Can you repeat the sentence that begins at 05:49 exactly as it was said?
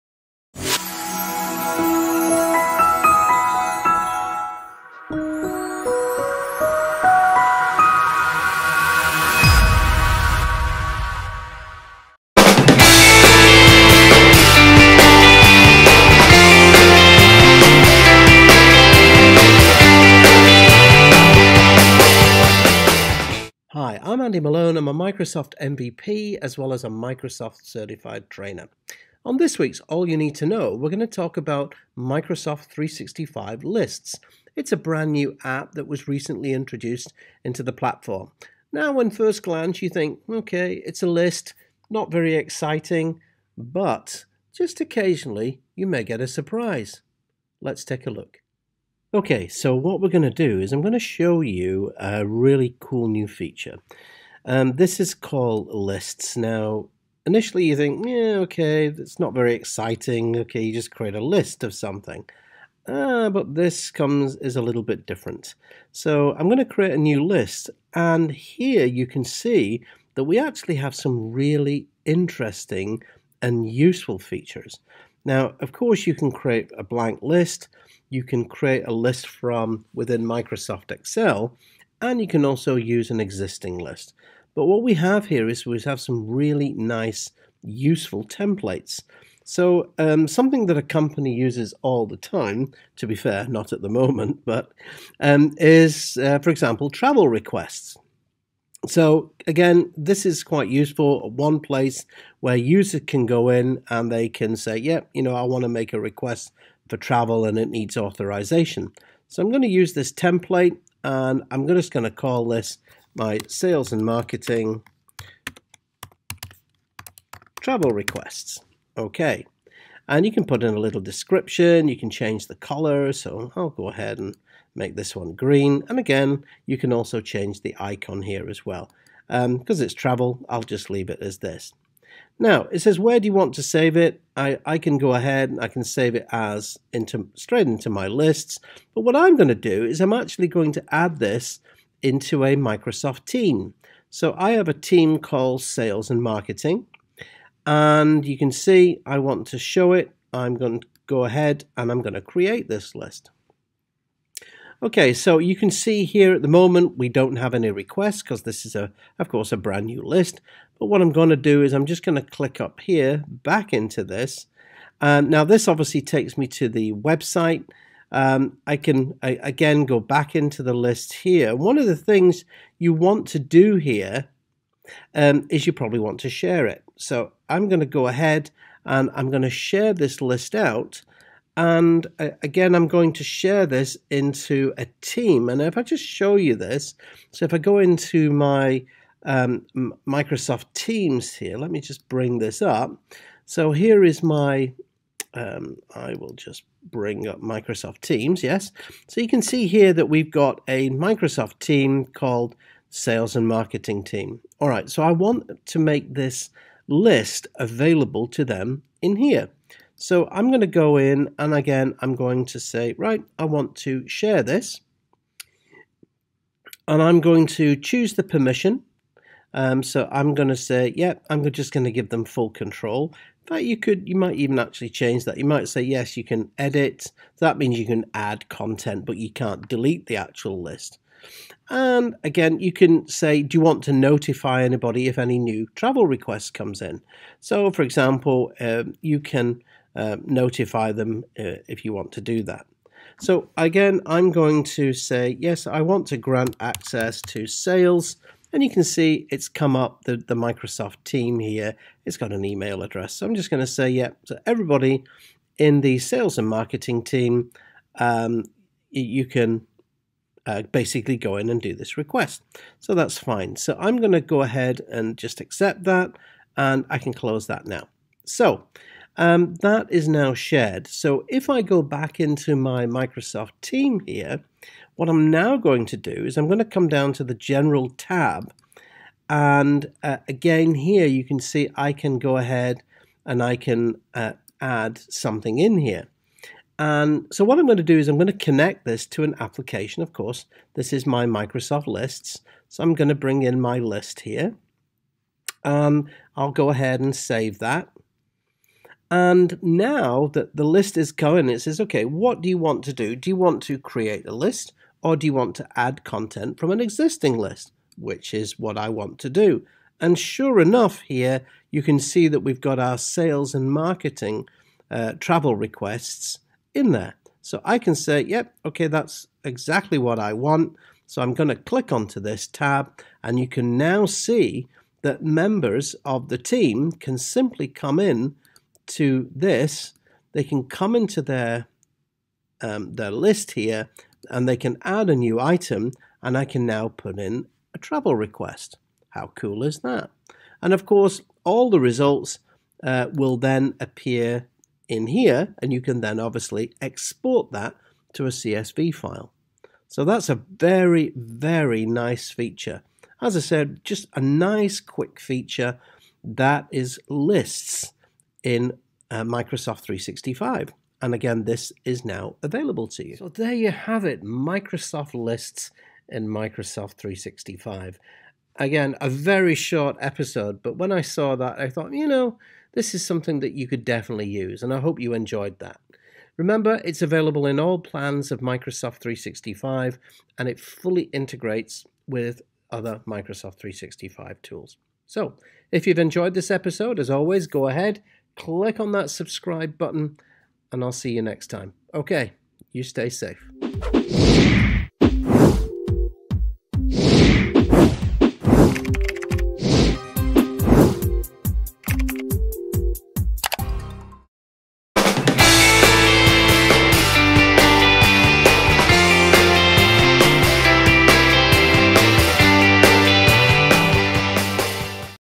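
So that's a very, very nice feature.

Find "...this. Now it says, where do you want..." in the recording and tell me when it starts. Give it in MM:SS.
02:11.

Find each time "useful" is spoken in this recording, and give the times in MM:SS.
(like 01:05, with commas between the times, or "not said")
01:13, 01:27, 01:40.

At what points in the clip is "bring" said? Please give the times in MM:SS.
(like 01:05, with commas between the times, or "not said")
03:12, 03:16, 04:53.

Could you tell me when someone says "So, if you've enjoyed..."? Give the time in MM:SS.
06:25.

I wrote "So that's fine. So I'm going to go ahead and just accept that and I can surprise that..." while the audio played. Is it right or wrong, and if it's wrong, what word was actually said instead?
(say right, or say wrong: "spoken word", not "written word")
wrong: "close", not "surprise".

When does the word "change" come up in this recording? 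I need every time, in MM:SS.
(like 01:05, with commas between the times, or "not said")
02:02, 02:07, 03:44.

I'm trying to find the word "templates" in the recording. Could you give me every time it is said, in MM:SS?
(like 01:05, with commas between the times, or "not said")
01:28, 01:50.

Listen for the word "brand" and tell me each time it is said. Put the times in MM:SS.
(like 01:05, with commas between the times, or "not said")
00:34, 02:39.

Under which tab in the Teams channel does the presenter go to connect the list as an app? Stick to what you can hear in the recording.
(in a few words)
General.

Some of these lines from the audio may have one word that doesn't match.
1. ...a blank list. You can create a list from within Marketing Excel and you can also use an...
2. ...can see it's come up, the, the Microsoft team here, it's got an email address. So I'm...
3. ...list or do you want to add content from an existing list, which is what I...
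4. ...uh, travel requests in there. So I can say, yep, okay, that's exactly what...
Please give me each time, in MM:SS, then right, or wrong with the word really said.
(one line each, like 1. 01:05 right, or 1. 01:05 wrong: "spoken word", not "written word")
1. 01:16 wrong: "Microsoft", not "Marketing"
2. 04:08 right
3. 05:04 right
4. 05:14 right.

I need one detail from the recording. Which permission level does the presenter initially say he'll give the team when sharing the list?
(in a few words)
Full control.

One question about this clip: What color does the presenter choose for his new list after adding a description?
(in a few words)
Green.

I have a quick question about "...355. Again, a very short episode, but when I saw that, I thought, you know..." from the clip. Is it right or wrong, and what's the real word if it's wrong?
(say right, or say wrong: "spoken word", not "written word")
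wrong: "365", not "355".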